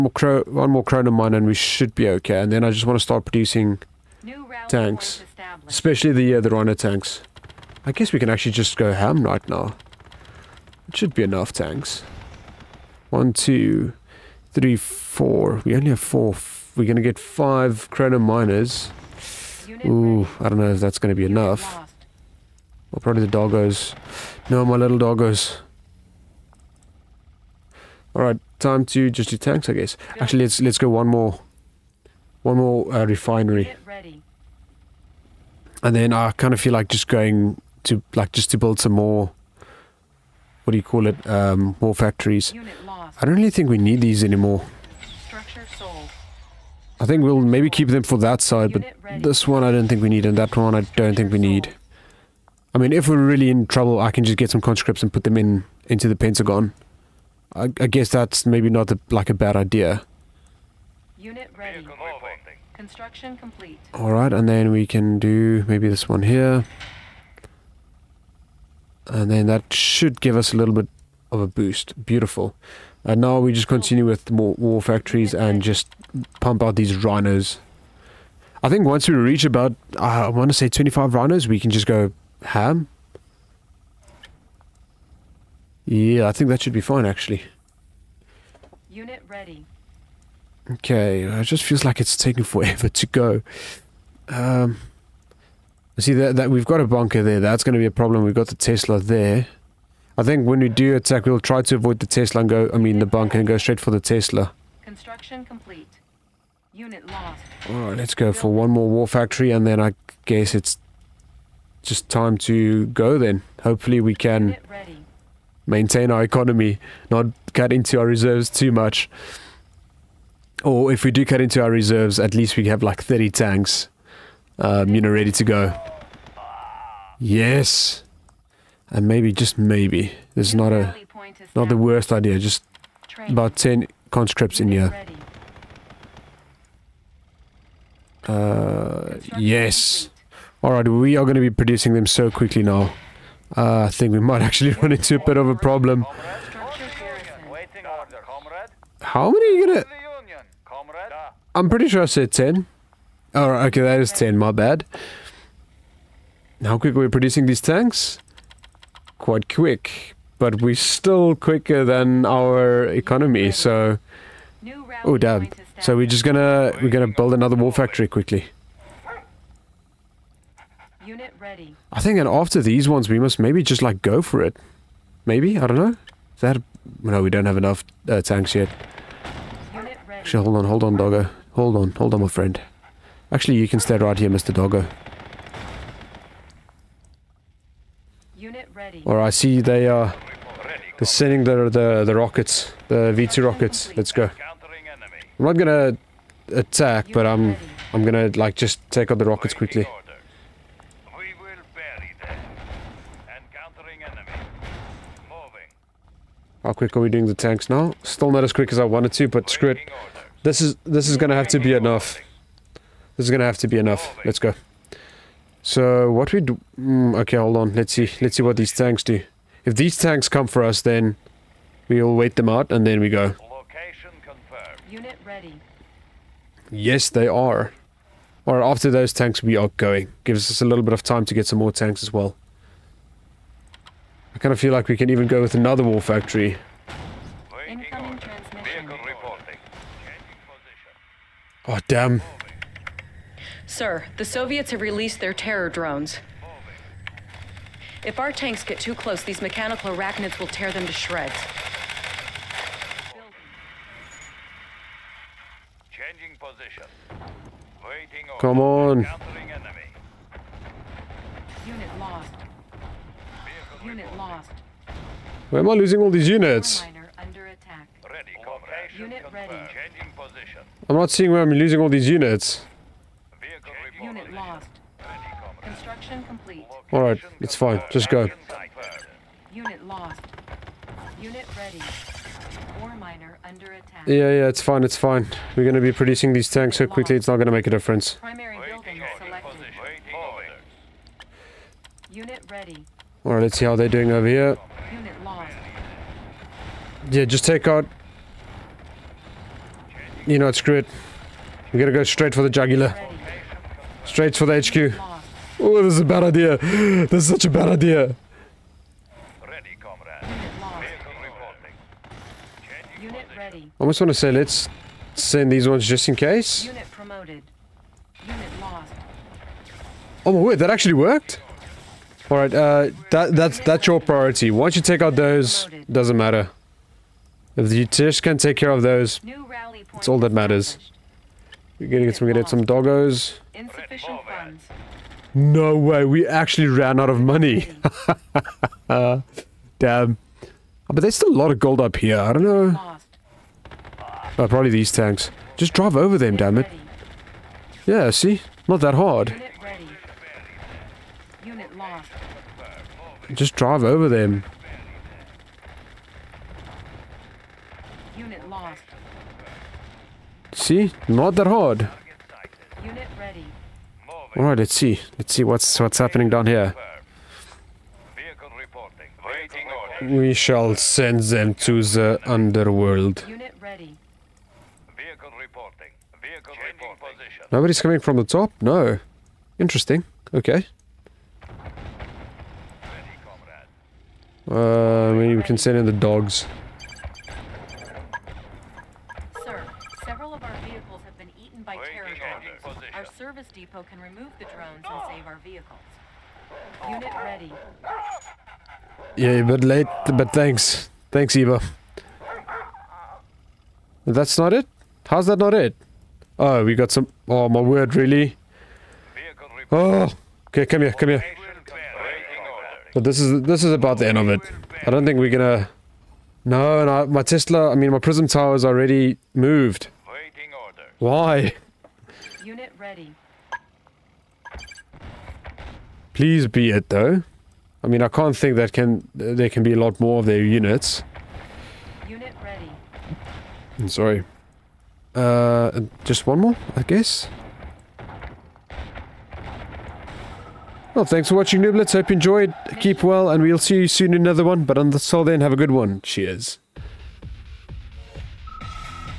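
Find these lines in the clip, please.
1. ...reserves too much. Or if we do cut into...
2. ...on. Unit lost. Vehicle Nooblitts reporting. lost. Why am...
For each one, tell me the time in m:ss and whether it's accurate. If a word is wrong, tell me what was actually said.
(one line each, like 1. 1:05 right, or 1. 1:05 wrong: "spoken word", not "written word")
1. 1:58 right
2. 4:18 wrong: "Unit", not "Nooblitts".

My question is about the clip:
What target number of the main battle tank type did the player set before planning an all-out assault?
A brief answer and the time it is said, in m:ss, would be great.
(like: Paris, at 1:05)
25, at 1:20.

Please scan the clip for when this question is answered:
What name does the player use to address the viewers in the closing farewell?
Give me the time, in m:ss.
7:21.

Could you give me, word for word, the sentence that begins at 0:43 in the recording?
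I don't really think we need these anymore.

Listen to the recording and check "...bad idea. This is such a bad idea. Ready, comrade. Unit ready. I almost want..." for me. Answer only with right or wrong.
right.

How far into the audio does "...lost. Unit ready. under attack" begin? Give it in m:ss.
4:39.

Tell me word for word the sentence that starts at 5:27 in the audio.
If you just can take care of those, it's all that matters.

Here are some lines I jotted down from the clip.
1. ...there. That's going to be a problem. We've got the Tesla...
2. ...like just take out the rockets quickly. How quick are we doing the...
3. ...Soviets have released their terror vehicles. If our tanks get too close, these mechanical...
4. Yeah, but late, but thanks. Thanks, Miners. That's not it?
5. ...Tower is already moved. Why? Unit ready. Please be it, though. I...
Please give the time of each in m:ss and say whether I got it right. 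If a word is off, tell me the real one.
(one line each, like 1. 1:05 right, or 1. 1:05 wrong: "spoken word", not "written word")
1. 1:37 right
2. 3:18 right
3. 4:04 wrong: "drones", not "vehicles"
4. 6:39 wrong: "Eva", not "Miners"
5. 6:58 right.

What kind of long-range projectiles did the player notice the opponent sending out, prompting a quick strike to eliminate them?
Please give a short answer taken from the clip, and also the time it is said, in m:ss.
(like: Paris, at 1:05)
V2 rockets, at 3:13.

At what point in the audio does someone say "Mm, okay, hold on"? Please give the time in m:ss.
3:36.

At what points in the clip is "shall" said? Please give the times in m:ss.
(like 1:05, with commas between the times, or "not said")
6:10.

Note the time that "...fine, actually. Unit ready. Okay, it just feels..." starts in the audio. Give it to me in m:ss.
1:26.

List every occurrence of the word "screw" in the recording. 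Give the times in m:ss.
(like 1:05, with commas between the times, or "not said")
3:29, 5:00.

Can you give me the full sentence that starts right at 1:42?
I mean the bunker and go straight for the Tesla.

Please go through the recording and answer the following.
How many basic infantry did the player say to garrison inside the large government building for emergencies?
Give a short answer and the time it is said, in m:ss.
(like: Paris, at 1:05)
10, at 2:13.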